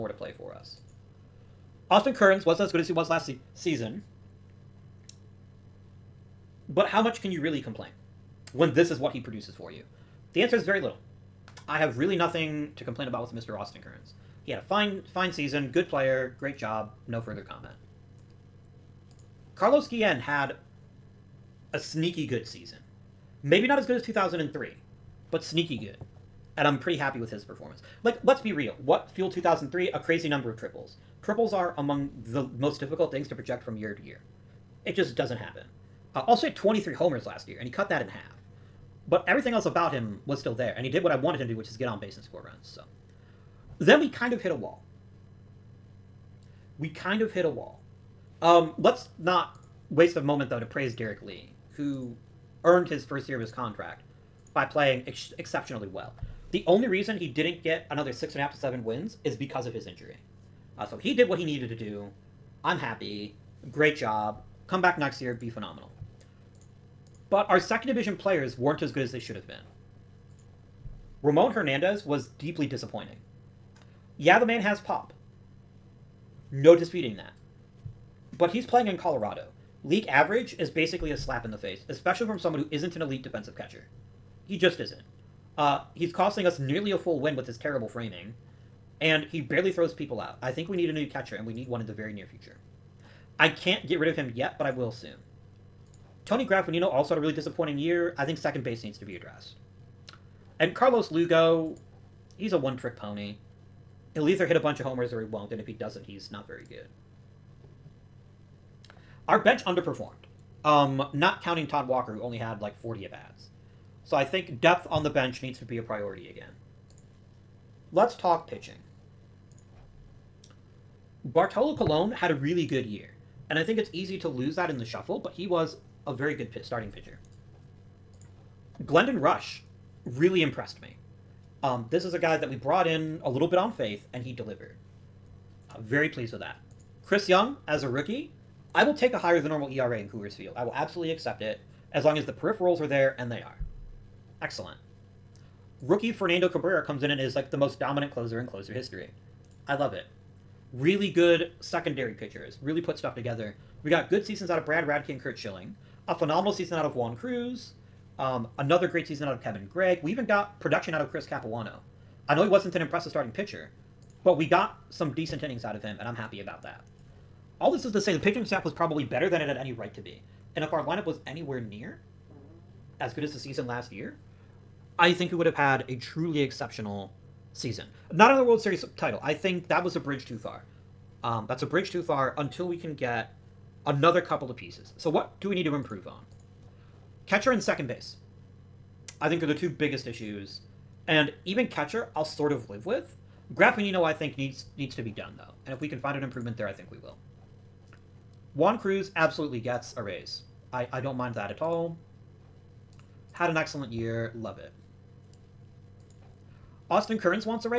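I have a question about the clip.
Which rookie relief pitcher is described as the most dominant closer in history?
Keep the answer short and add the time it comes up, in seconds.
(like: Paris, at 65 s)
Fernando Cabrera, at 146 s.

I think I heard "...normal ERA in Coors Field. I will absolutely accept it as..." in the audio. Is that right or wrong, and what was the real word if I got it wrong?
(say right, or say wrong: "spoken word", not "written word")
right.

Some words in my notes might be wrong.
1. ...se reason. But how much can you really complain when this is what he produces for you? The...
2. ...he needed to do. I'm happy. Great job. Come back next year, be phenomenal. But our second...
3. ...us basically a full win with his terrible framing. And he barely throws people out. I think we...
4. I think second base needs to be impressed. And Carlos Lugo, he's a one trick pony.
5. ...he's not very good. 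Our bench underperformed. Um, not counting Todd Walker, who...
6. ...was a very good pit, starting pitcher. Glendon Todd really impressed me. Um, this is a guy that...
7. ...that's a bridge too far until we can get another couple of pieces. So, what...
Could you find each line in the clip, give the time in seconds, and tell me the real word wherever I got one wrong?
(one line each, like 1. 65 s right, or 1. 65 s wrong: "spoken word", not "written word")
1. 3 s wrong: "season", not "reason"
2. 61 s right
3. 86 s wrong: "nearly", not "basically"
4. 98 s wrong: "addressed", not "impressed"
5. 106 s right
6. 125 s wrong: "Rusch", not "Todd"
7. 181 s right.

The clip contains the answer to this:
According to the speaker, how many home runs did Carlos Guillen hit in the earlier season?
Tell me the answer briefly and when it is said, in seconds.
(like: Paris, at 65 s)
23, at 36 s.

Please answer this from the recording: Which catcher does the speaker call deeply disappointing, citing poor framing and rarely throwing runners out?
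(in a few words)
Ramon Hernandez.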